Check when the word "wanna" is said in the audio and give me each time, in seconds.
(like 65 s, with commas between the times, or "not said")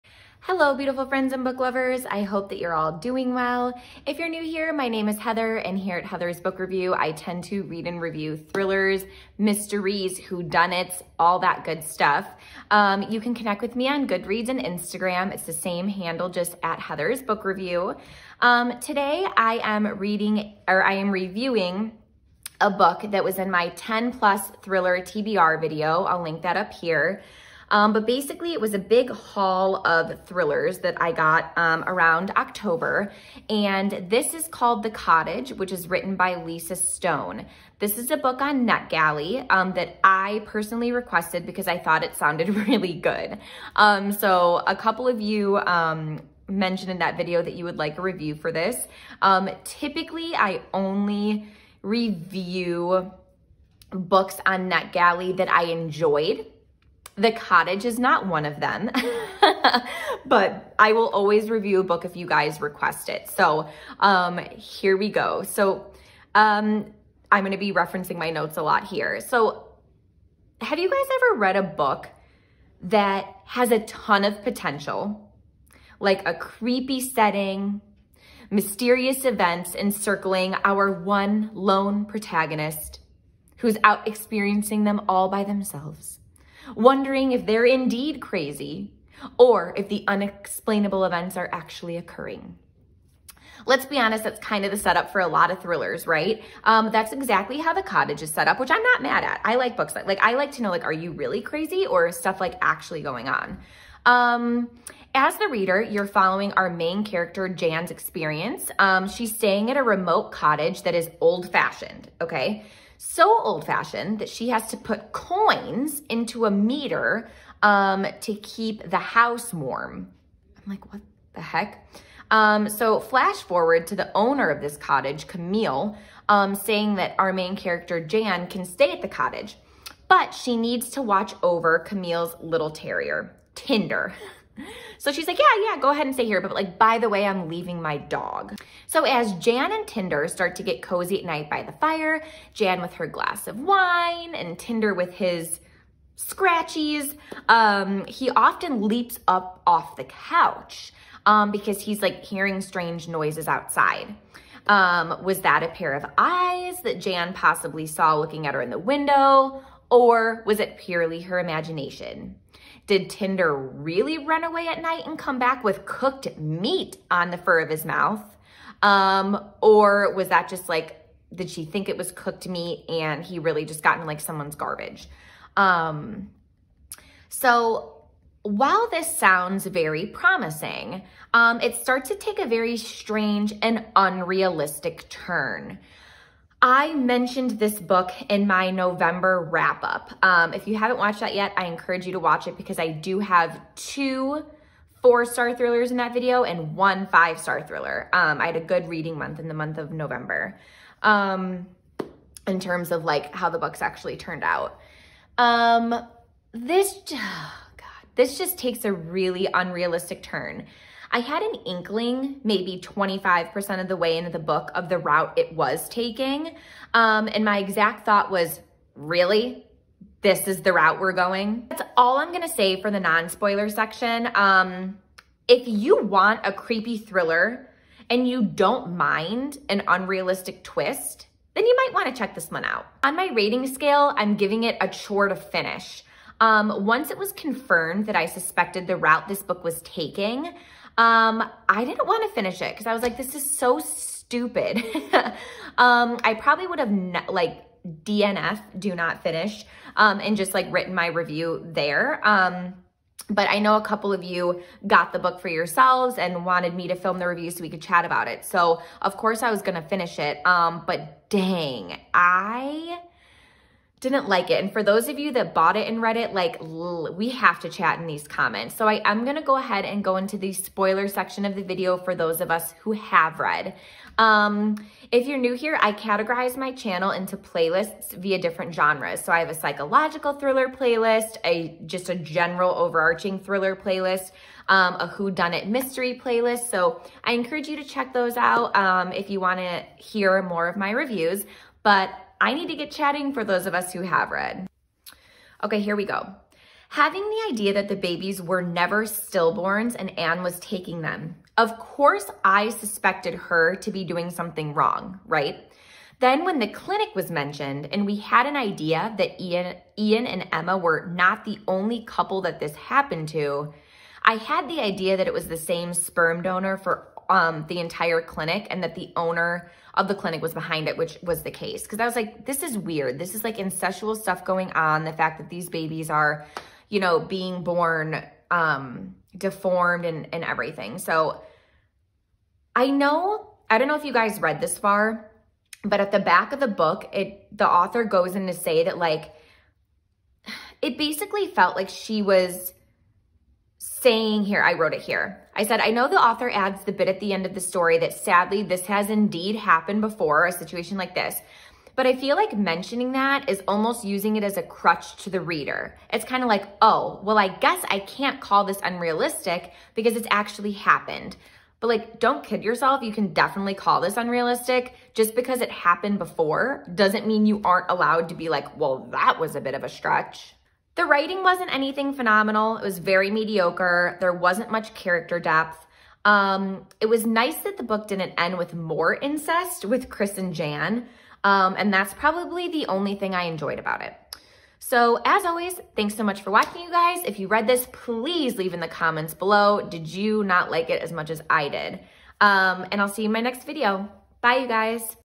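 231 s, 289 s.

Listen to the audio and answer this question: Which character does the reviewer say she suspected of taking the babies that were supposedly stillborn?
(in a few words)
Anne.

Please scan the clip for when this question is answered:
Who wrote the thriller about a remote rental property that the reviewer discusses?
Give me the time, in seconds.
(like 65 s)
36 s.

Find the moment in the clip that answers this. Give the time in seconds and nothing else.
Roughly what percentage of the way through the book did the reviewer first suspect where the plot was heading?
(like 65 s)
212 s.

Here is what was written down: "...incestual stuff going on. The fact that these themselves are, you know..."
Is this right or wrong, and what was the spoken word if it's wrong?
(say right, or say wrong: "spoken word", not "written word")
wrong: "babies", not "themselves".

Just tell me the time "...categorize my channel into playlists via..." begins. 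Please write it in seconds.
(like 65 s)
275 s.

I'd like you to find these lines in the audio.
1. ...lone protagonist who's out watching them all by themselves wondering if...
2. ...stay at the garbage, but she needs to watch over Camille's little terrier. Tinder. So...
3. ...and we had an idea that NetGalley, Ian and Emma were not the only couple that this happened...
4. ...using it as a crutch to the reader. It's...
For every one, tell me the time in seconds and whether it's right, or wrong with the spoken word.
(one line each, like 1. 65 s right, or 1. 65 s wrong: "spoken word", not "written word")
1. 81 s wrong: "experiencing", not "watching"
2. 128 s wrong: "cottage", not "garbage"
3. 307 s wrong: "Ian", not "NetGalley"
4. 354 s right.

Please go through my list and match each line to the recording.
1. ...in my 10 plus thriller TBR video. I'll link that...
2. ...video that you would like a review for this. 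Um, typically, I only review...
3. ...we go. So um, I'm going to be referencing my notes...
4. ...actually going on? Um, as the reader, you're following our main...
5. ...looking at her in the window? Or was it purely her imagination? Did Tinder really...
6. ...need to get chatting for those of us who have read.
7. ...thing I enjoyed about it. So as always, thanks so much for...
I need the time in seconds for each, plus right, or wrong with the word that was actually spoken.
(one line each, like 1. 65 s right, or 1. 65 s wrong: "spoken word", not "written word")
1. 23 s right
2. 47 s right
3. 64 s right
4. 102 s right
5. 158 s right
6. 292 s right
7. 383 s right.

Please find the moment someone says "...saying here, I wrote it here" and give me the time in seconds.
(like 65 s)
343 s.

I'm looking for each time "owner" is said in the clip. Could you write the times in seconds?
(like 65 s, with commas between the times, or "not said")
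124 s, 319 s.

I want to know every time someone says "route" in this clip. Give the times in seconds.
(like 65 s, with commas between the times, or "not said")
214 s, 220 s, 238 s.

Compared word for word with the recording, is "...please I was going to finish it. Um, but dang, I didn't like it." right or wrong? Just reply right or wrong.
wrong.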